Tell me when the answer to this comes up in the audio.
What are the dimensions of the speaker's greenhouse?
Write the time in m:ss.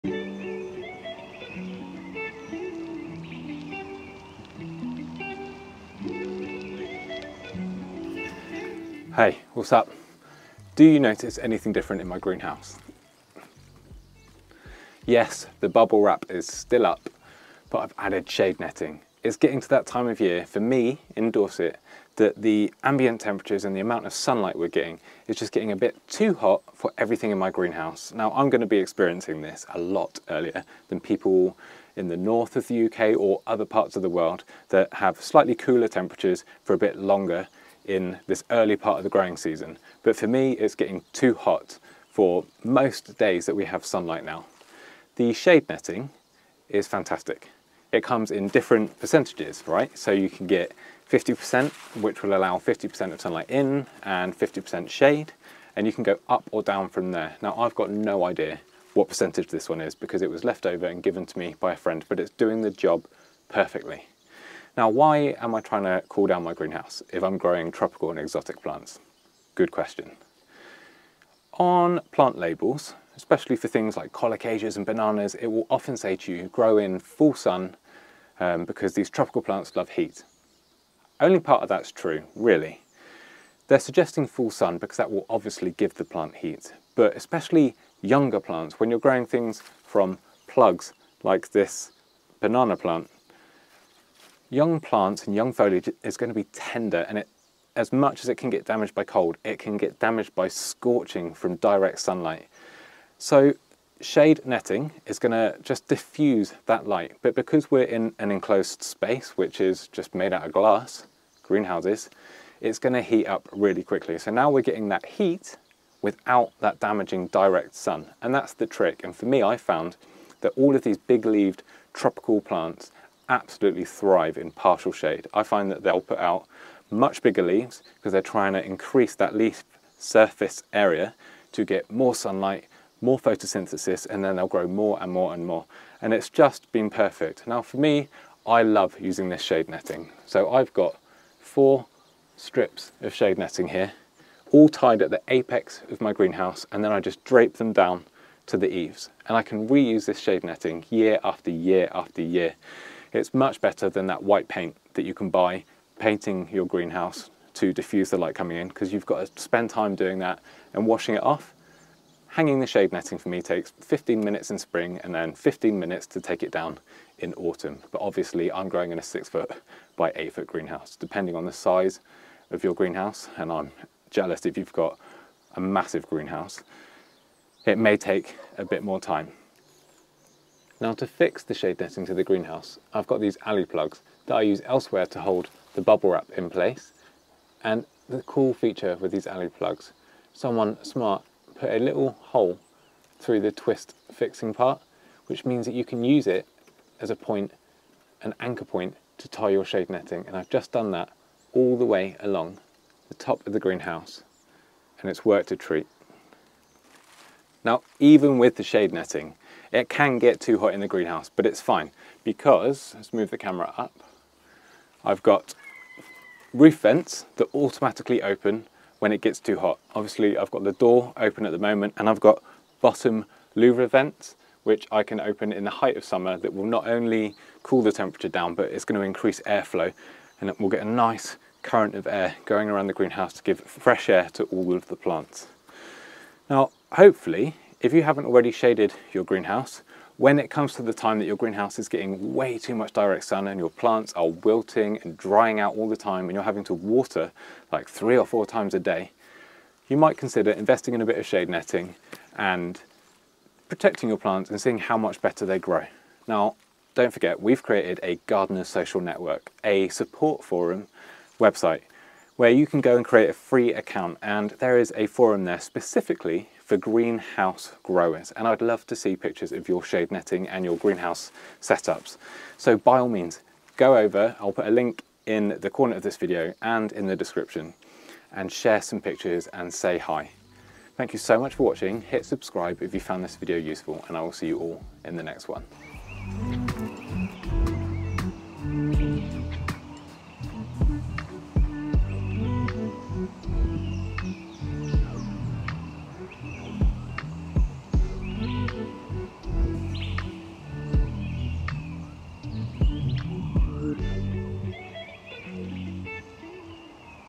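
2:49.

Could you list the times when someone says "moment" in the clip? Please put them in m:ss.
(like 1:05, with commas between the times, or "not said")
3:41.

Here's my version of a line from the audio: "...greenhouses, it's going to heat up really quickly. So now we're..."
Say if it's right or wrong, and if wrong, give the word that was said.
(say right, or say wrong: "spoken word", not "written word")
right.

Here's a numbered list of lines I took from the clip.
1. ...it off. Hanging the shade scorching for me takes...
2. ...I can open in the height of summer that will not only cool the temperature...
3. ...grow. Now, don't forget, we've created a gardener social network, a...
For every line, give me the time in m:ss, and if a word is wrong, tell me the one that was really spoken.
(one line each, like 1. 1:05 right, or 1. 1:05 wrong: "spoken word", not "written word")
1. 2:41 wrong: "netting", not "scorching"
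2. 3:44 right
3. 4:15 right.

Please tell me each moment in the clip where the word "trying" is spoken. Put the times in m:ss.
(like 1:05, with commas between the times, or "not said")
1:05, 2:08.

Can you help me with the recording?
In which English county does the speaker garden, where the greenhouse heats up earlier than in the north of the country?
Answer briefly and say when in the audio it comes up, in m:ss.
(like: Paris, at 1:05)
Dorset, at 0:21.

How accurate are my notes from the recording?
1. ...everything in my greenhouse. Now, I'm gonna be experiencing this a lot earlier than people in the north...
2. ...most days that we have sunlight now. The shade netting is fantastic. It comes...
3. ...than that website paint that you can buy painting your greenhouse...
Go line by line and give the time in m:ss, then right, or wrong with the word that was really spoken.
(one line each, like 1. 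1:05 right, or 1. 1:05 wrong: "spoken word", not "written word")
1. 0:26 right
2. 0:42 right
3. 2:33 wrong: "white", not "website".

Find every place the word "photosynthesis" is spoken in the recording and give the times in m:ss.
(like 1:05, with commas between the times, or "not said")
2:13.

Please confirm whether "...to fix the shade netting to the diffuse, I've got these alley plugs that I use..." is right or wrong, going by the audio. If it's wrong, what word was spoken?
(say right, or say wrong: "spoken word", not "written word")
wrong: "greenhouse", not "diffuse".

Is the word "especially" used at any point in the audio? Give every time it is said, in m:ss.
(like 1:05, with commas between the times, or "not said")
1:13, 1:27.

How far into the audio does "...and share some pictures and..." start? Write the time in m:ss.
4:38.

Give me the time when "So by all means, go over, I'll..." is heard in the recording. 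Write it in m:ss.
4:32.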